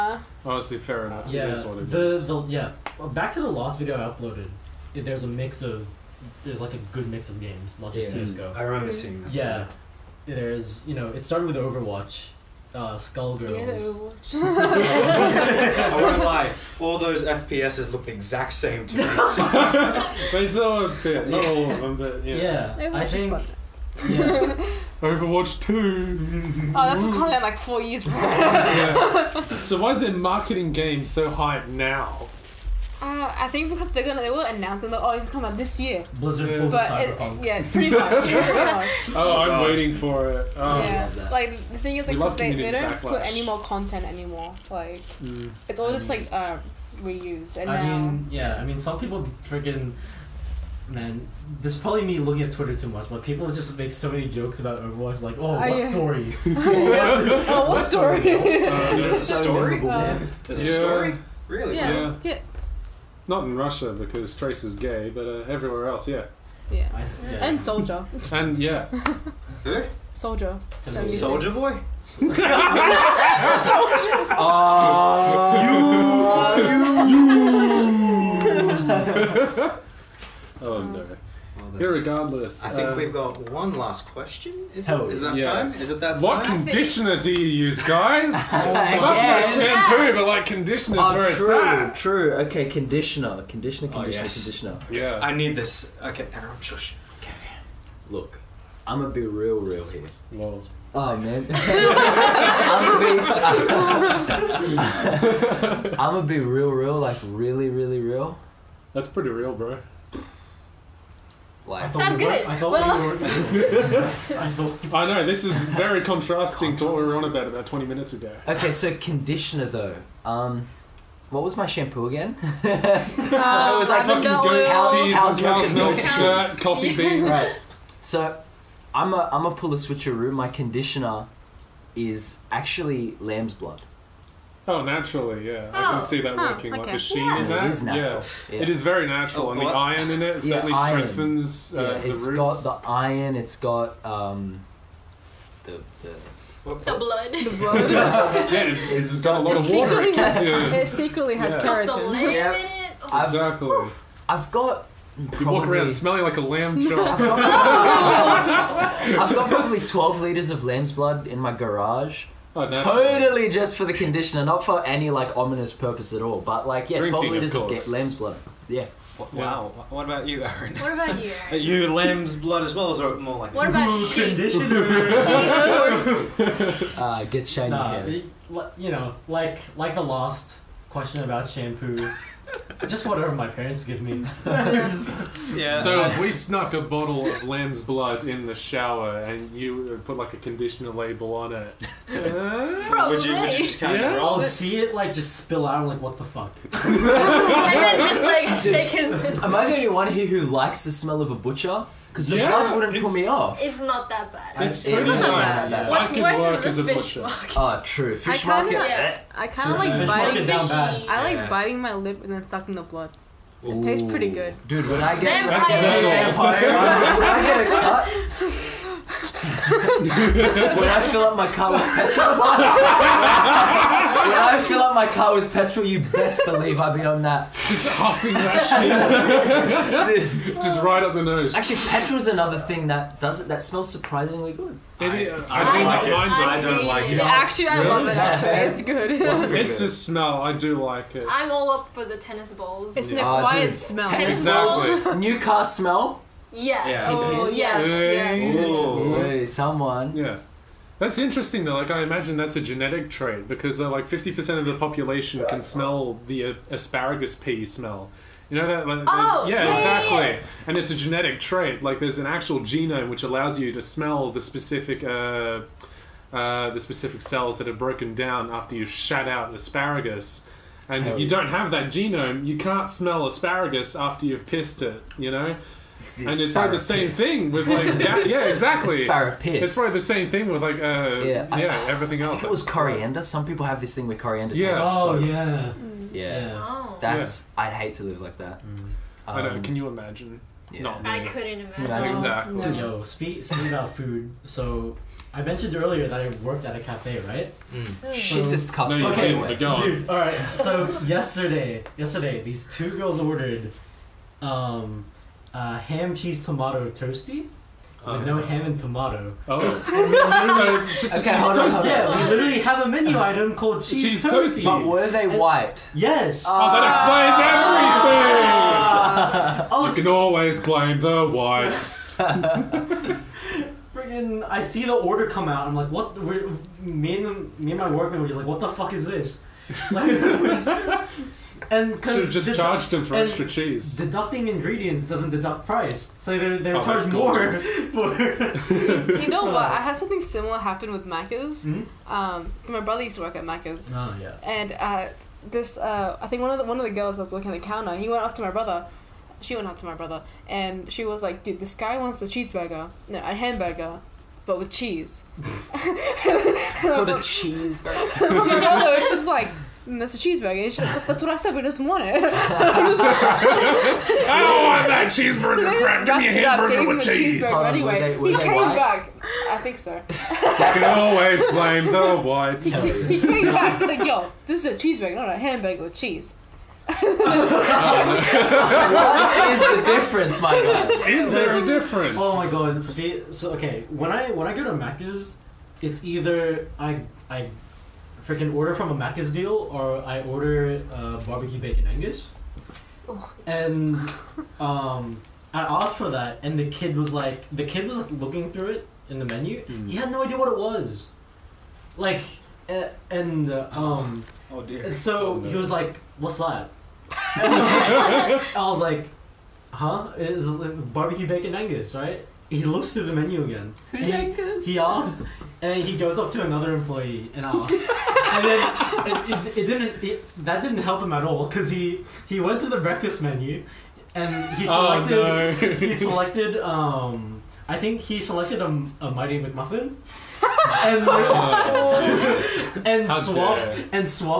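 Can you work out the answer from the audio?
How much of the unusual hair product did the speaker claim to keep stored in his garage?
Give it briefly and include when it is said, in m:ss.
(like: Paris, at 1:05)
12 litres, at 2:39.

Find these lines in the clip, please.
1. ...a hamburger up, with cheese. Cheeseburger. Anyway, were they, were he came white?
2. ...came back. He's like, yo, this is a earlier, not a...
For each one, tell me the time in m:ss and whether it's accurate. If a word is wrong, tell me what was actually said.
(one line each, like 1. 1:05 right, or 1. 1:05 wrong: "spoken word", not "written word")
1. 6:06 right
2. 6:13 wrong: "cheeseburger", not "earlier".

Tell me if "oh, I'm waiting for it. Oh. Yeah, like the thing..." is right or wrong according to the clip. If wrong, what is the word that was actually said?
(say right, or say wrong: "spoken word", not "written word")
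right.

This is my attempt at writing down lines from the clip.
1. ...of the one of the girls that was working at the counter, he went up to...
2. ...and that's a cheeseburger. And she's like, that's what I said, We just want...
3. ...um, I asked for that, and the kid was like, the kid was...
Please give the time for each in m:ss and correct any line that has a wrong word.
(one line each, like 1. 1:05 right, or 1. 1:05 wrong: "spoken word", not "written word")
1. 5:46 right
2. 5:59 right
3. 6:34 right.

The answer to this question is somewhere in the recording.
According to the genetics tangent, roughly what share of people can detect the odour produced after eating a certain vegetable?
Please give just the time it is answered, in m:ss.
4:14.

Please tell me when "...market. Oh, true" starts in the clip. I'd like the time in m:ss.
3:27.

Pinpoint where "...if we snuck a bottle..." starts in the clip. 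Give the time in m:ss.
3:06.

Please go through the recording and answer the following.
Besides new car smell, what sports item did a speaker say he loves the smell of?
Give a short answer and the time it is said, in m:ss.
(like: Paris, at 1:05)
Tennis balls, at 4:02.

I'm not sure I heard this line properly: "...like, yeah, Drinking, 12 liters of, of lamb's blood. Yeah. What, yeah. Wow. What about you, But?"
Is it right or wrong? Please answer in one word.
wrong.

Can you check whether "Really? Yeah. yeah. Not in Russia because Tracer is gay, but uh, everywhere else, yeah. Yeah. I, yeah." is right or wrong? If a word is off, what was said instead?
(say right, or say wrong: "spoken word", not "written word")
right.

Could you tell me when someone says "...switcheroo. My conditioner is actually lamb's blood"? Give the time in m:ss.
2:09.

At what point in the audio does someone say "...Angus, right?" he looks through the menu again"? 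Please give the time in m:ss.
6:51.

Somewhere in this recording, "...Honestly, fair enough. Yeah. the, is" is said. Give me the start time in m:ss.
0:00.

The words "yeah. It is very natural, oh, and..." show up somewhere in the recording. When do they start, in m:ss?
2:18.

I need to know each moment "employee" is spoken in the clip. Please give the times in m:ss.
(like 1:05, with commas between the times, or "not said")
6:56.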